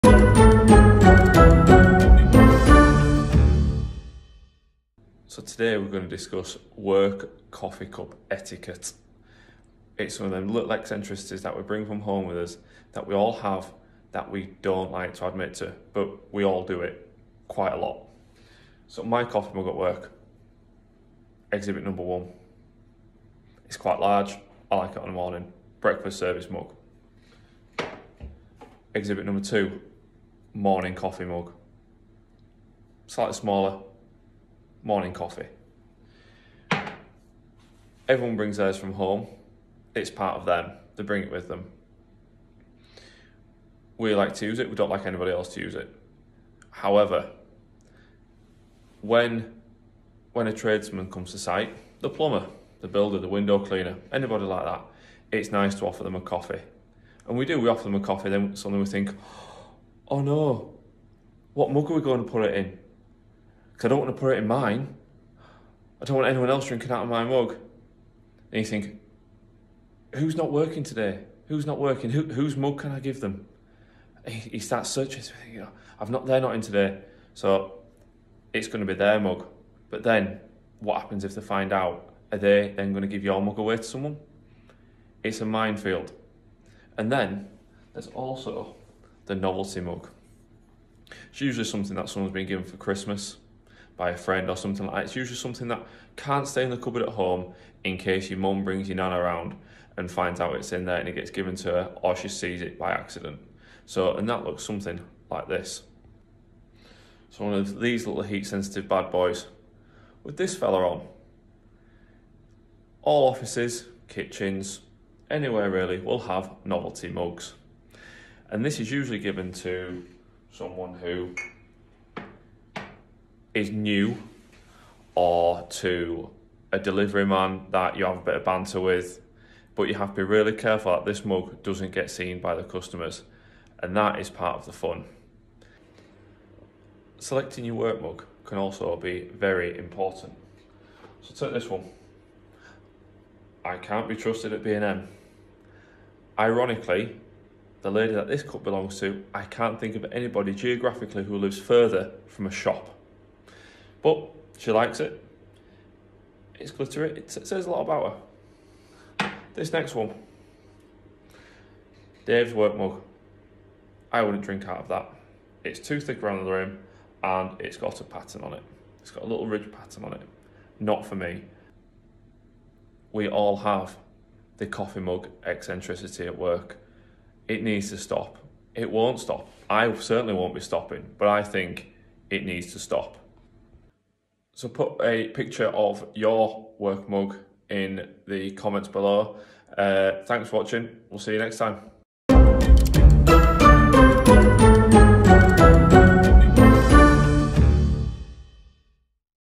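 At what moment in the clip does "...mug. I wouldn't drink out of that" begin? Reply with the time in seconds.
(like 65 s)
162 s.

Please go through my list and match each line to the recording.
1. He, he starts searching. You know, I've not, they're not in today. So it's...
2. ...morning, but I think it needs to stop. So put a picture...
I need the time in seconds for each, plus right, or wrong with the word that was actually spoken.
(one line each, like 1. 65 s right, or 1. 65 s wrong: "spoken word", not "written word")
1. 74 s right
2. 180 s wrong: "stopping", not "morning".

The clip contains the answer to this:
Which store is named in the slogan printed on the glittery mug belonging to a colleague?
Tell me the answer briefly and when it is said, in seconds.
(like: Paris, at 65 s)
B&M, at 144 s.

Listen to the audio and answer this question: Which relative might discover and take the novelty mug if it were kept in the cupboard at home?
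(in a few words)
Nan.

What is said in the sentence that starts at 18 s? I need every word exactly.
So my coffee mug at work, exhibit number one.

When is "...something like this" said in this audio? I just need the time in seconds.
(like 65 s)
104 s.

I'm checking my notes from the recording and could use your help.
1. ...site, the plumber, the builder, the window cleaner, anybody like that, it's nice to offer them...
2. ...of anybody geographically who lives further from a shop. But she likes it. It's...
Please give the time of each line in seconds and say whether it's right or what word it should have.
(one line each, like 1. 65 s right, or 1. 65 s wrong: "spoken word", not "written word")
1. 51 s right
2. 149 s right.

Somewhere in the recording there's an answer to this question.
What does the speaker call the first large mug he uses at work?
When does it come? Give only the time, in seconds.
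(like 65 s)
25 s.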